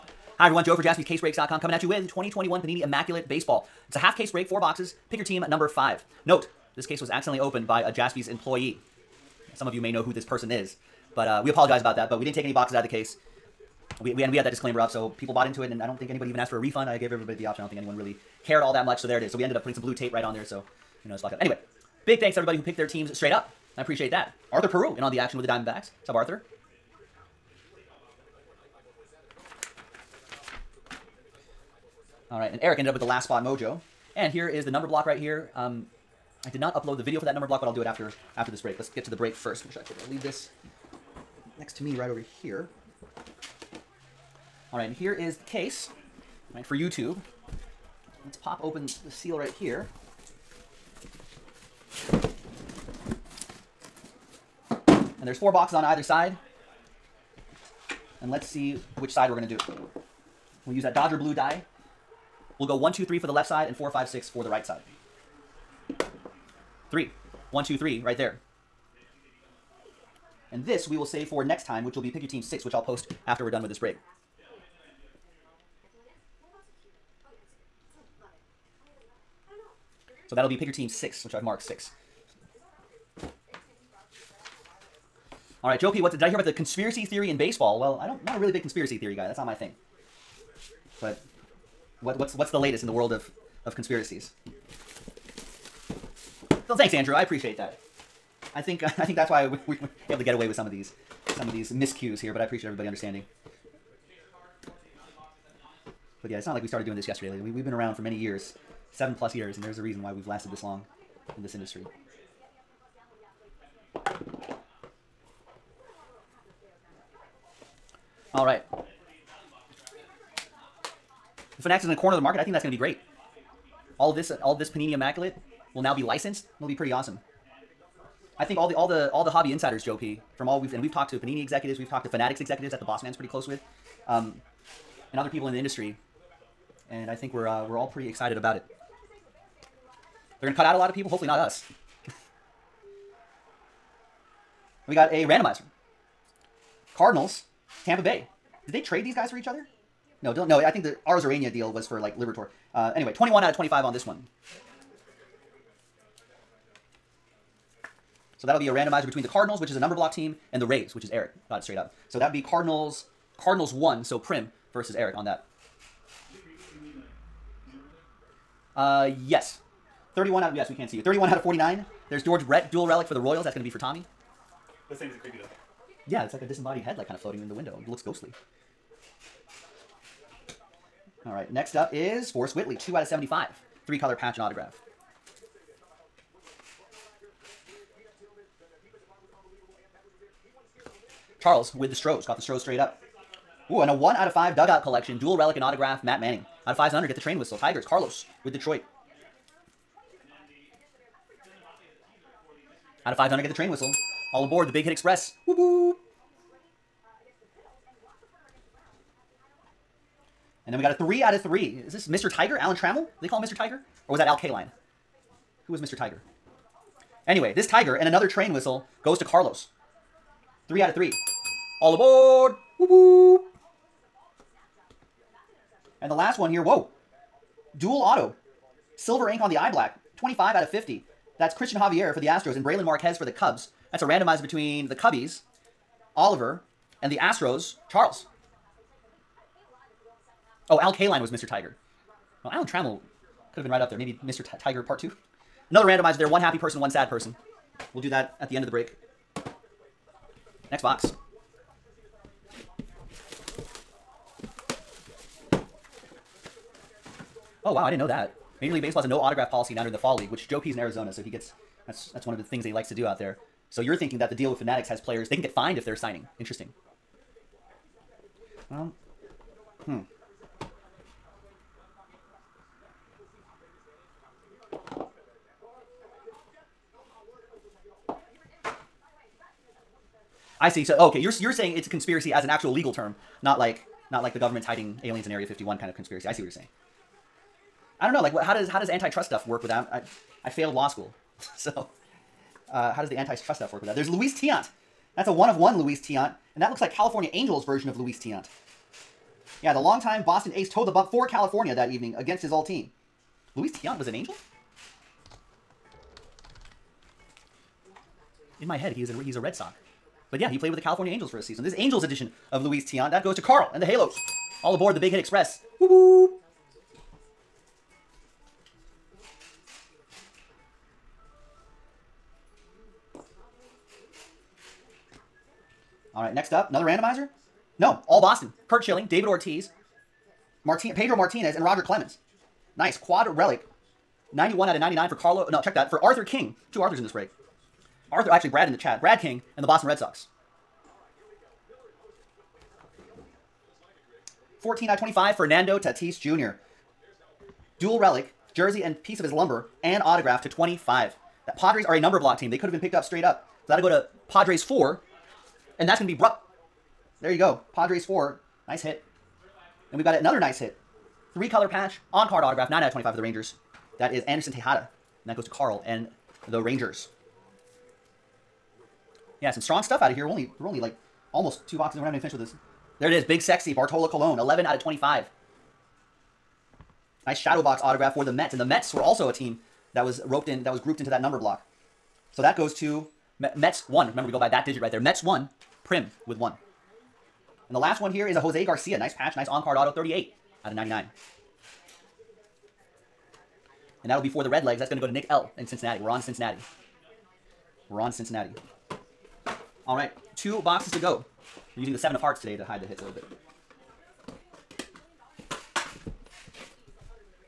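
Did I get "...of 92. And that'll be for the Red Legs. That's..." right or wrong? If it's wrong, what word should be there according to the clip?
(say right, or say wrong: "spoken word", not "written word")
wrong: "99", not "92".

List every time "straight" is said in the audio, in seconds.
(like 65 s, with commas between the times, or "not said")
23 s, 161 s, 192 s, 353 s.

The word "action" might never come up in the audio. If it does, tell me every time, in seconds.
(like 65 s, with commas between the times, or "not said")
25 s.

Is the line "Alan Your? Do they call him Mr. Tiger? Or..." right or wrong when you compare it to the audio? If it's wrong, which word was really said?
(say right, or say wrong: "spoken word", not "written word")
wrong: "Trammell", not "Your".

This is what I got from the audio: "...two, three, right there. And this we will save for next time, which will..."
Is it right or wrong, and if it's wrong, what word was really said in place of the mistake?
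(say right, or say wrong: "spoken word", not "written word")
right.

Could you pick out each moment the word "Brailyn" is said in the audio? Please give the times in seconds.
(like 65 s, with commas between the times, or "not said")
232 s.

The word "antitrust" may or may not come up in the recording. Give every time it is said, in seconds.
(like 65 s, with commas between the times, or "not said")
288 s, 293 s.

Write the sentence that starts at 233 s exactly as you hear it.
That's a randomizer between the Cubbies, Oliver, and the Astros, Charles.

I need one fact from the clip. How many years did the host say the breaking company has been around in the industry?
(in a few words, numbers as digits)
seven plus years.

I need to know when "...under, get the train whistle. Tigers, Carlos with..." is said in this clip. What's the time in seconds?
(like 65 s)
196 s.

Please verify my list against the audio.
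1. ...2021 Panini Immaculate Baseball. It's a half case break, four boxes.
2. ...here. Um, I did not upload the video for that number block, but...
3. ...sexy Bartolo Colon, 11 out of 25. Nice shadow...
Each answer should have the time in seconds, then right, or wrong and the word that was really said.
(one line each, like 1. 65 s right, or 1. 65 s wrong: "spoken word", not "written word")
1. 2 s right
2. 35 s right
3. 373 s right.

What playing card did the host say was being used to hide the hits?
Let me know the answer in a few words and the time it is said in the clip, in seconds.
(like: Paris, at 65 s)
seven of hearts, at 401 s.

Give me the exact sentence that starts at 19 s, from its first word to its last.
So we ended up putting some blue tape right on there.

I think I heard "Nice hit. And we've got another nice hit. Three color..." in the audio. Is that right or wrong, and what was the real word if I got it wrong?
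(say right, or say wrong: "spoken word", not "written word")
right.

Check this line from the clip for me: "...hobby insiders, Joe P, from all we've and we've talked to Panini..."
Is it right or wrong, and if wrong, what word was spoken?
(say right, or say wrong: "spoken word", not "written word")
right.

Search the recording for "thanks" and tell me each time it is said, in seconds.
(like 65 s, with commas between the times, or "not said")
22 s, 96 s.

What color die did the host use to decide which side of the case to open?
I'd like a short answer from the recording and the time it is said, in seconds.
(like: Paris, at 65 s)
Dodger blue, at 60 s.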